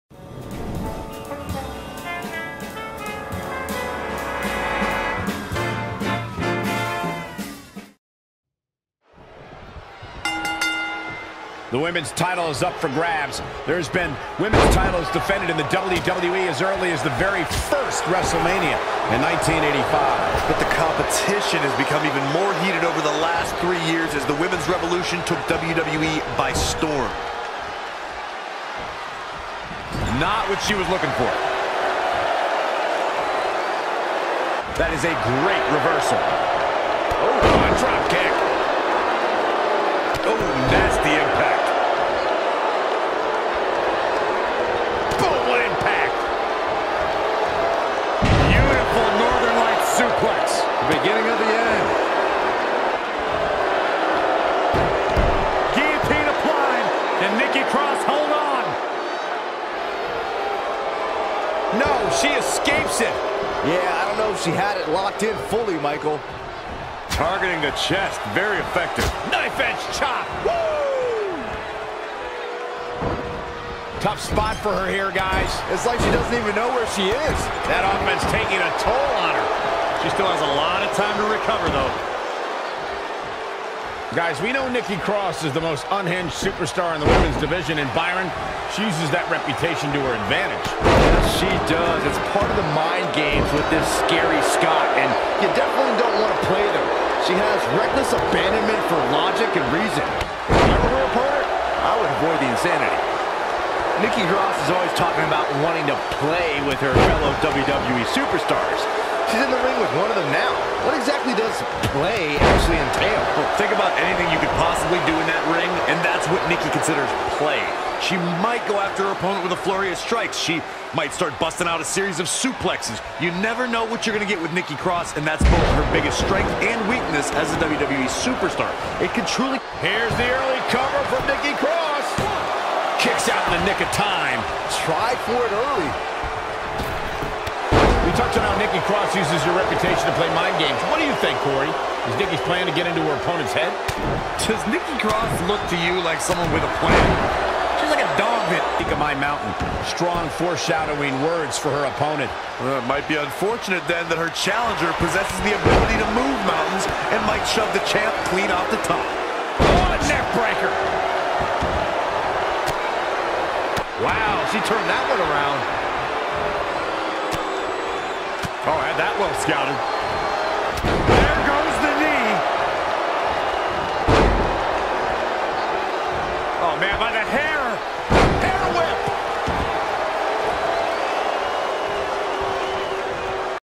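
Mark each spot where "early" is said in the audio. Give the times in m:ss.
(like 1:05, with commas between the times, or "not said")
0:16, 2:10, 2:15.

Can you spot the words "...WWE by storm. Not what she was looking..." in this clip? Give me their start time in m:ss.
0:25.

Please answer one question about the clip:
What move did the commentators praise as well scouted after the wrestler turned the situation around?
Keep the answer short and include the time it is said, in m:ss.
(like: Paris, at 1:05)
Neck breaker, at 2:40.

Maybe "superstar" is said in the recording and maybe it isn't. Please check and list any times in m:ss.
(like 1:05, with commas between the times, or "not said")
1:26, 1:48, 2:08.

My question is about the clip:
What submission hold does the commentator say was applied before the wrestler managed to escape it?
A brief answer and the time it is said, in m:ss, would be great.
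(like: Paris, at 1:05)
Guillotine, at 0:55.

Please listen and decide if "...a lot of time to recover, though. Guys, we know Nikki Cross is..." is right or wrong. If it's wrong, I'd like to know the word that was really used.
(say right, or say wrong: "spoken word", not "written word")
right.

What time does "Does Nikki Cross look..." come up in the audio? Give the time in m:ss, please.
2:24.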